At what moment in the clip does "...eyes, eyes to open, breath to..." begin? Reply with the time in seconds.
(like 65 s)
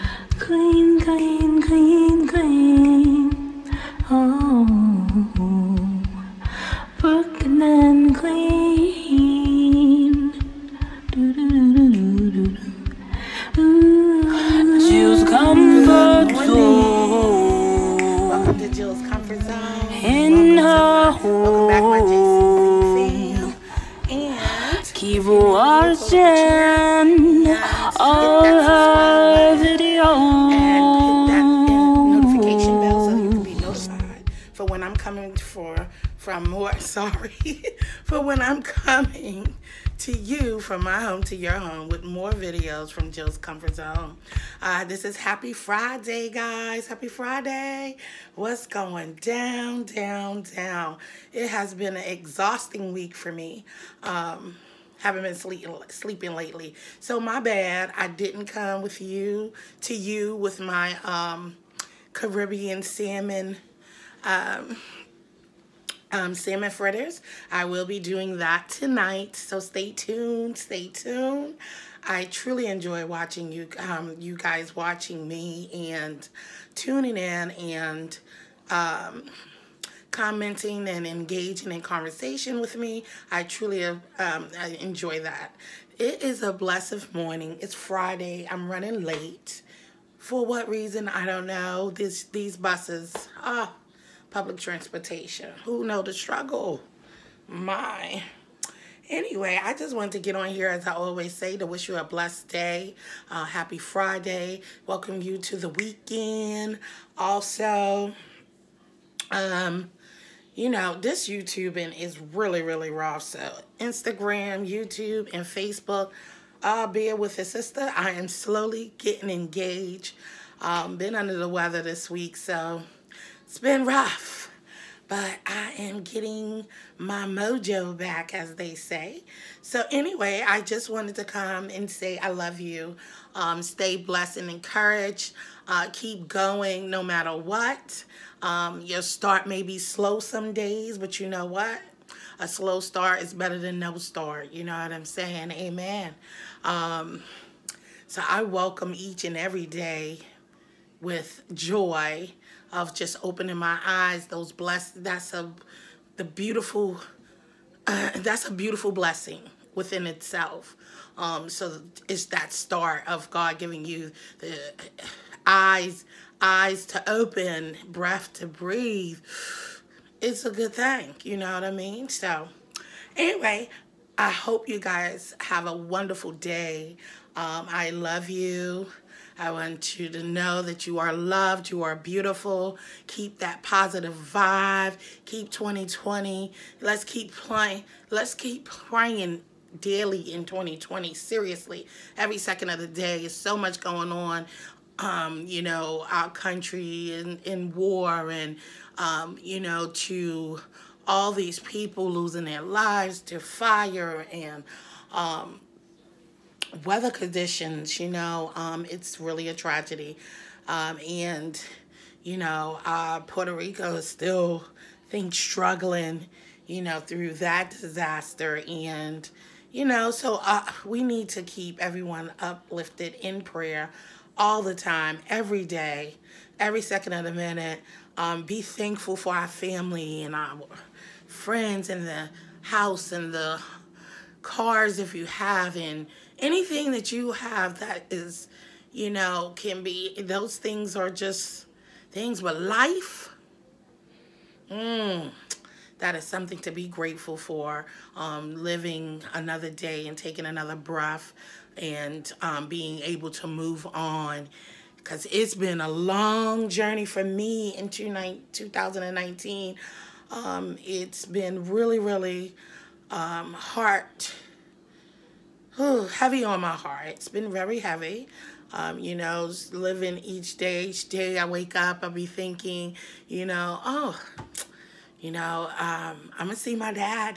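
165 s.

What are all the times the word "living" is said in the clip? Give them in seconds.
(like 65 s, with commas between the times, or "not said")
248 s, 269 s.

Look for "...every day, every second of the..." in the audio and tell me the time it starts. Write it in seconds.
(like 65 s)
225 s.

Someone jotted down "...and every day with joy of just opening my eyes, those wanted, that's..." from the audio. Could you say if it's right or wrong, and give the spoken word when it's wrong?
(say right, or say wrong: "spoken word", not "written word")
wrong: "blessed", not "wanted".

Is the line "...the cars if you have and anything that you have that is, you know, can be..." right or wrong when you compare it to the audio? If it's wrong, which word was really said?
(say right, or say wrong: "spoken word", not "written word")
right.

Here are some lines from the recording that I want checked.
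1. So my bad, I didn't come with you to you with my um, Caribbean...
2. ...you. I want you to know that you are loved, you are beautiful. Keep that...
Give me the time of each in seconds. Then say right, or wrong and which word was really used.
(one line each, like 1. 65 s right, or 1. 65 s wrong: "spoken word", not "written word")
1. 56 s right
2. 178 s right.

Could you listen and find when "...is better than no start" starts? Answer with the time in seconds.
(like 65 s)
143 s.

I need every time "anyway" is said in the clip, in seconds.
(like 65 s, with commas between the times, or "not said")
99 s, 129 s, 173 s.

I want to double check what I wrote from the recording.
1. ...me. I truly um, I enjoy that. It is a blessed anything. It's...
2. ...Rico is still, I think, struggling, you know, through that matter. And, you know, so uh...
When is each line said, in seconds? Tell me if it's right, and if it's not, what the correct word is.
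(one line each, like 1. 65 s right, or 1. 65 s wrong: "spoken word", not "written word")
1. 82 s wrong: "morning", not "anything"
2. 213 s wrong: "disaster", not "matter".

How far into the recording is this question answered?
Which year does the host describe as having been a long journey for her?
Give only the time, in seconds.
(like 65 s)
257 s.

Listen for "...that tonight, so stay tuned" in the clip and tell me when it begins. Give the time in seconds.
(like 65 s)
68 s.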